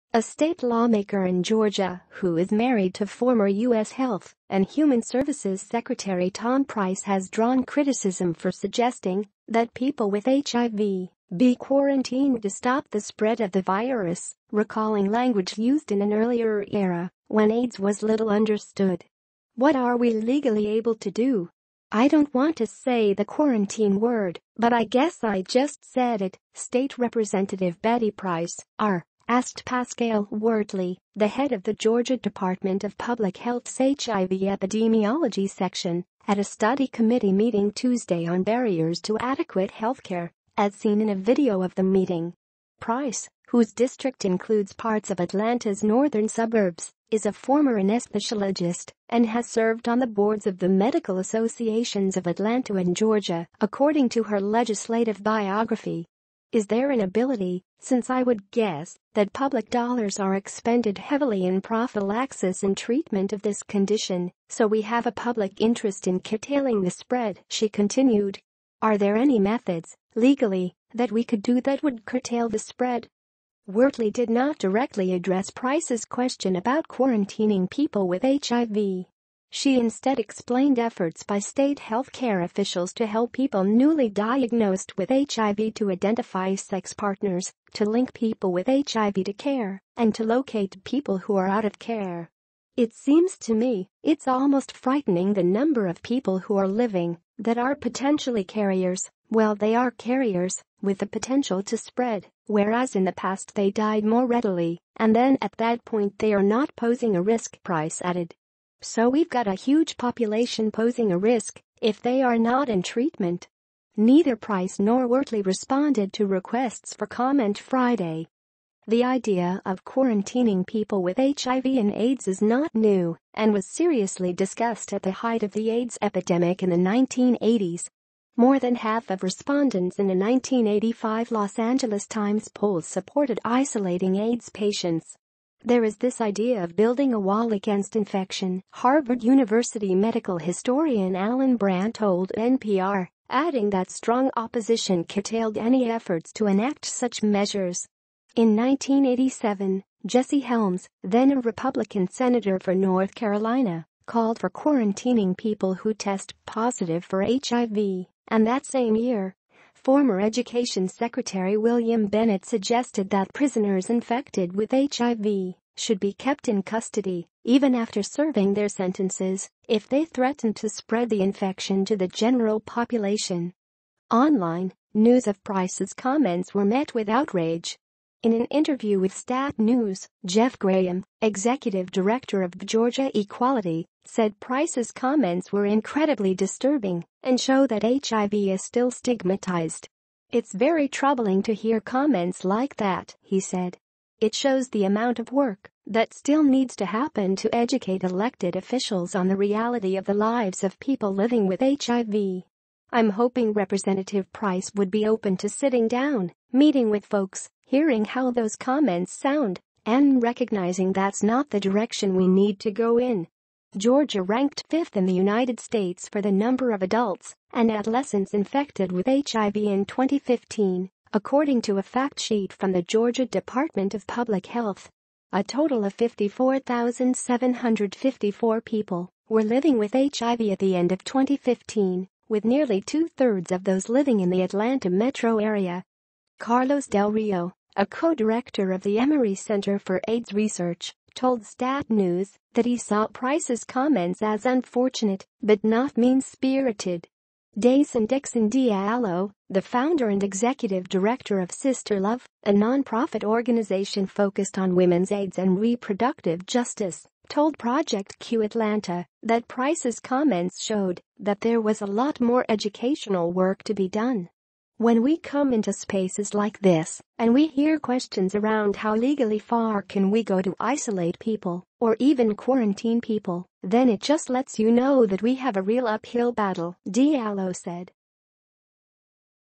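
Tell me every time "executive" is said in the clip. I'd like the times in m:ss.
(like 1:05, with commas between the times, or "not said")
3:01, 4:10.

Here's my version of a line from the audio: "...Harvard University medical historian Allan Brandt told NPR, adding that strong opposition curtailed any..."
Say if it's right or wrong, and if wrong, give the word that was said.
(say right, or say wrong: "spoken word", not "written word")
right.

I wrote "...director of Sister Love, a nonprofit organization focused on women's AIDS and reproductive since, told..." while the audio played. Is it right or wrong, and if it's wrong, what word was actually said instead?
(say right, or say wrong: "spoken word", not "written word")
wrong: "justice", not "since".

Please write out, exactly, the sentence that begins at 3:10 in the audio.
It's very troubling to hear comments like that, he said.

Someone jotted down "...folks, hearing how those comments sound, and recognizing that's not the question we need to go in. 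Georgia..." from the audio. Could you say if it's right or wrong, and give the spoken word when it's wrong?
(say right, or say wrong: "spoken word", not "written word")
wrong: "direction", not "question".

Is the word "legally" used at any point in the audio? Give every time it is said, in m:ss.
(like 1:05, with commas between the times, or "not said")
0:20, 1:10, 4:28.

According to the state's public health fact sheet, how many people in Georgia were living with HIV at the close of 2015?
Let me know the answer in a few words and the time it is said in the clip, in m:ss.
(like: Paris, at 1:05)
54,754, at 3:45.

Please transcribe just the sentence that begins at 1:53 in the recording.
Neither Price nor Wortley responded to requests for comment Friday.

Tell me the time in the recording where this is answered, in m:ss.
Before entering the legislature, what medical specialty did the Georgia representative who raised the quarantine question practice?
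0:47.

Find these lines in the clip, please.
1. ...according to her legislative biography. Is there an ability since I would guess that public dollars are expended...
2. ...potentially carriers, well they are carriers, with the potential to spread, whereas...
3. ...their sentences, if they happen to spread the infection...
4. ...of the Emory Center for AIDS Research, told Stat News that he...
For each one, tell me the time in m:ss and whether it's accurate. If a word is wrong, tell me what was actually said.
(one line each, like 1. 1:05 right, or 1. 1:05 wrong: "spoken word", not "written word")
1. 0:53 right
2. 1:37 right
3. 2:48 wrong: "threaten", not "happen"
4. 3:58 right.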